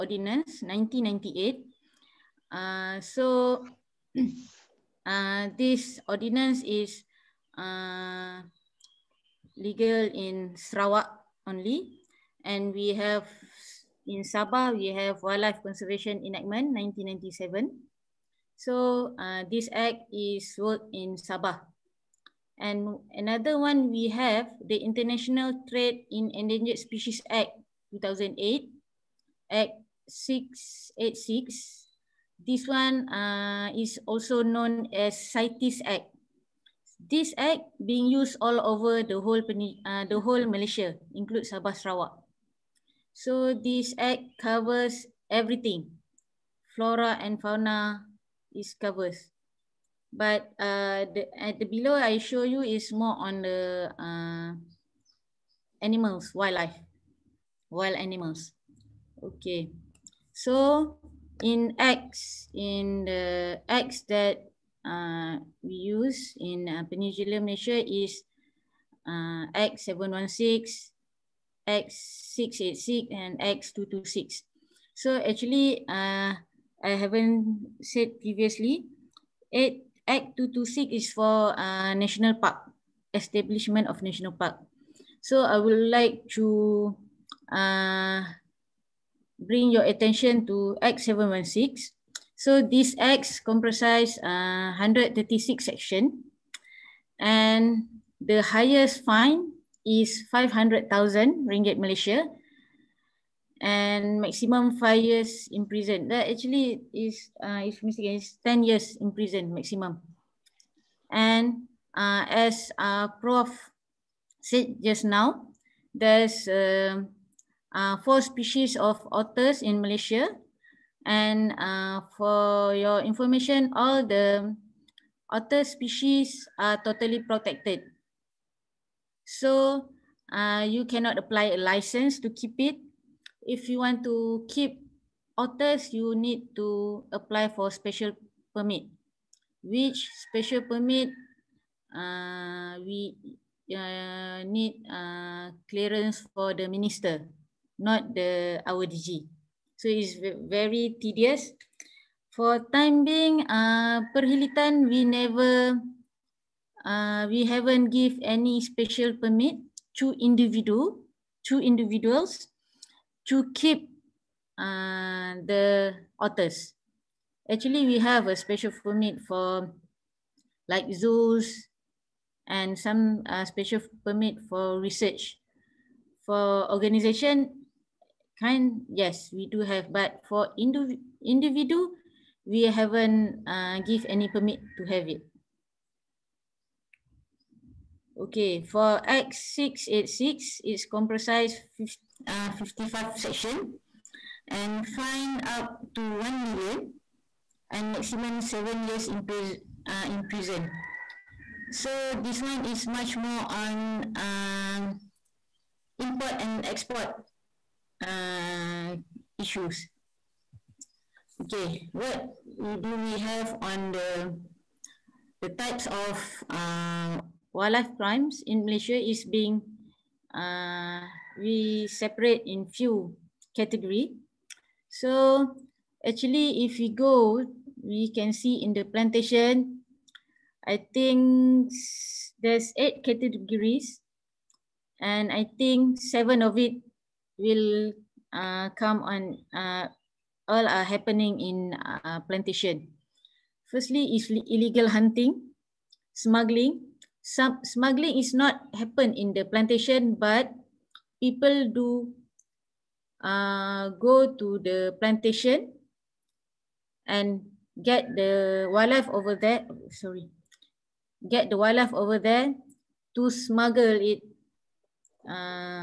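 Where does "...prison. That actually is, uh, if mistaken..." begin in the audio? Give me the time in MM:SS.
01:45.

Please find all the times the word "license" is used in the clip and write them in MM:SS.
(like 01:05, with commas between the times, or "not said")
02:11.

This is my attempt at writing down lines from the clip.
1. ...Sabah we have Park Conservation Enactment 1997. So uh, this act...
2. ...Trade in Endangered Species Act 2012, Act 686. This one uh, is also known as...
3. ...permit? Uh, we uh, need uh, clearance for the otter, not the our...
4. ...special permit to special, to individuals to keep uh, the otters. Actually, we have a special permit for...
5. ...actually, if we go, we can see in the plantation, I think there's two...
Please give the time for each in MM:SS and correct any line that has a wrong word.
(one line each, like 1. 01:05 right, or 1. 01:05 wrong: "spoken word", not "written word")
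1. 00:14 wrong: "Wildlife", not "Park"
2. 00:25 wrong: "2008", not "2012"
3. 02:20 wrong: "minister", not "otter"
4. 02:38 wrong: "individual", not "special"
5. 03:46 wrong: "eight", not "two".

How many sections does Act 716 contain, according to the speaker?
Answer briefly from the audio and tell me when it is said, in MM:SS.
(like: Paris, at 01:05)
136, at 01:34.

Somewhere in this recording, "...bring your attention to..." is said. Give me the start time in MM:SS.
01:29.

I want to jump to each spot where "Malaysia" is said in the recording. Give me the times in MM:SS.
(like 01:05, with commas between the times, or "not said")
00:40, 01:07, 01:41, 01:59, 03:38.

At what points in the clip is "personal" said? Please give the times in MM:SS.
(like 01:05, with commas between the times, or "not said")
not said.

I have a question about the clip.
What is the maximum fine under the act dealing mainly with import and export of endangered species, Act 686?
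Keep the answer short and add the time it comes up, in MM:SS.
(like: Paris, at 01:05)
1 million, at 03:16.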